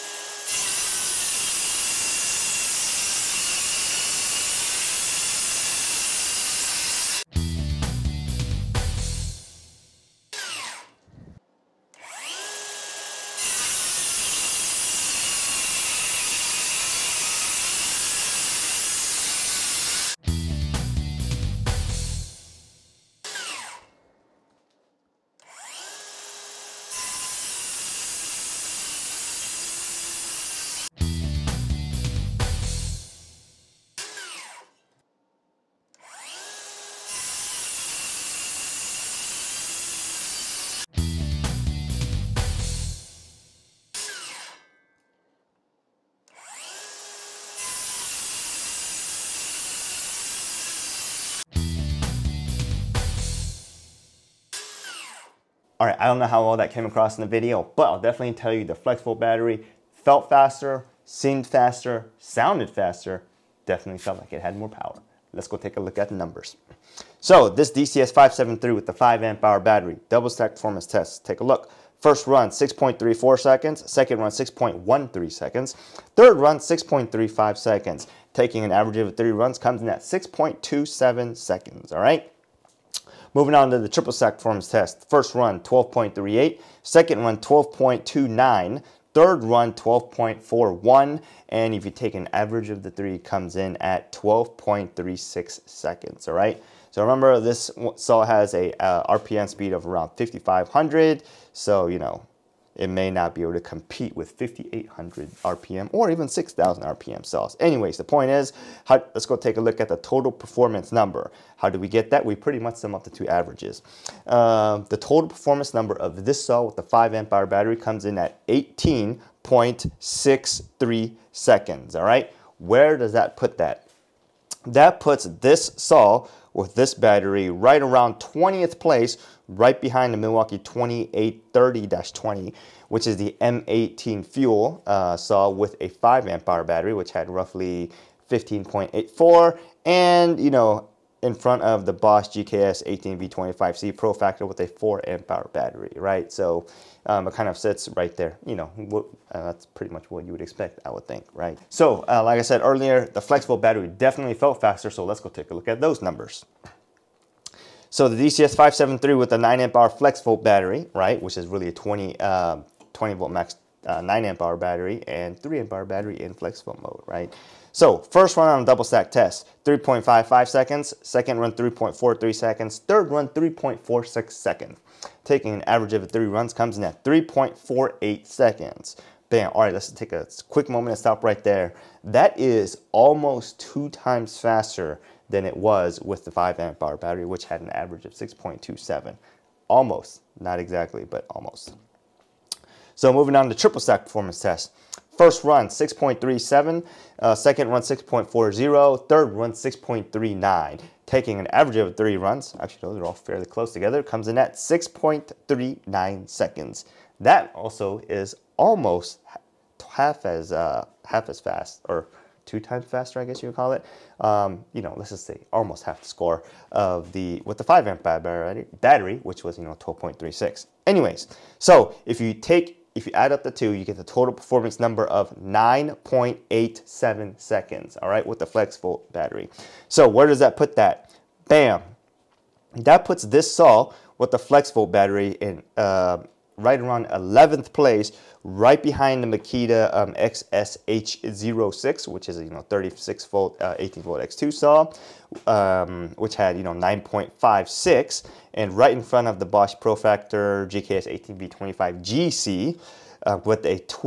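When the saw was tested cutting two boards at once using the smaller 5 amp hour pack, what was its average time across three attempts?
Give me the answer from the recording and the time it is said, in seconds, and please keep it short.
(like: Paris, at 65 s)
6.27 seconds, at 80 s.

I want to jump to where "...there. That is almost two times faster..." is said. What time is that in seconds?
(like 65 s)
181 s.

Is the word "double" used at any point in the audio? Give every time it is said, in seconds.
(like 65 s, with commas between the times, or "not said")
70 s, 168 s.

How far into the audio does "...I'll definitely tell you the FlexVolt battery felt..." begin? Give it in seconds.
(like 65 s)
57 s.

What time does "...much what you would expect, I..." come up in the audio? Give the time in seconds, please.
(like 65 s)
149 s.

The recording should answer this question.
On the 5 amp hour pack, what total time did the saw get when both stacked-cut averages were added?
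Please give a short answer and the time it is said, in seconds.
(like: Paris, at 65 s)
18.63 seconds, at 118 s.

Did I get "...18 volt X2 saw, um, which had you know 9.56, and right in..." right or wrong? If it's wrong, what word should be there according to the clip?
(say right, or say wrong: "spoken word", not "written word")
right.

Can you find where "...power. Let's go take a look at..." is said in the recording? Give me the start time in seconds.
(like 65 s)
64 s.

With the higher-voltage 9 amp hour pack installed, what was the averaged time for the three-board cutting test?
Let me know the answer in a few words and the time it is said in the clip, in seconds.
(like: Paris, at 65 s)
6.39 seconds, at 204 s.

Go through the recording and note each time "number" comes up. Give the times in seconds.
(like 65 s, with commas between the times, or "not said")
66 s, 110 s, 115 s, 156 s, 224 s.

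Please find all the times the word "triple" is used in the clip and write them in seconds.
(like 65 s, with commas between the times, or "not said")
83 s, 193 s.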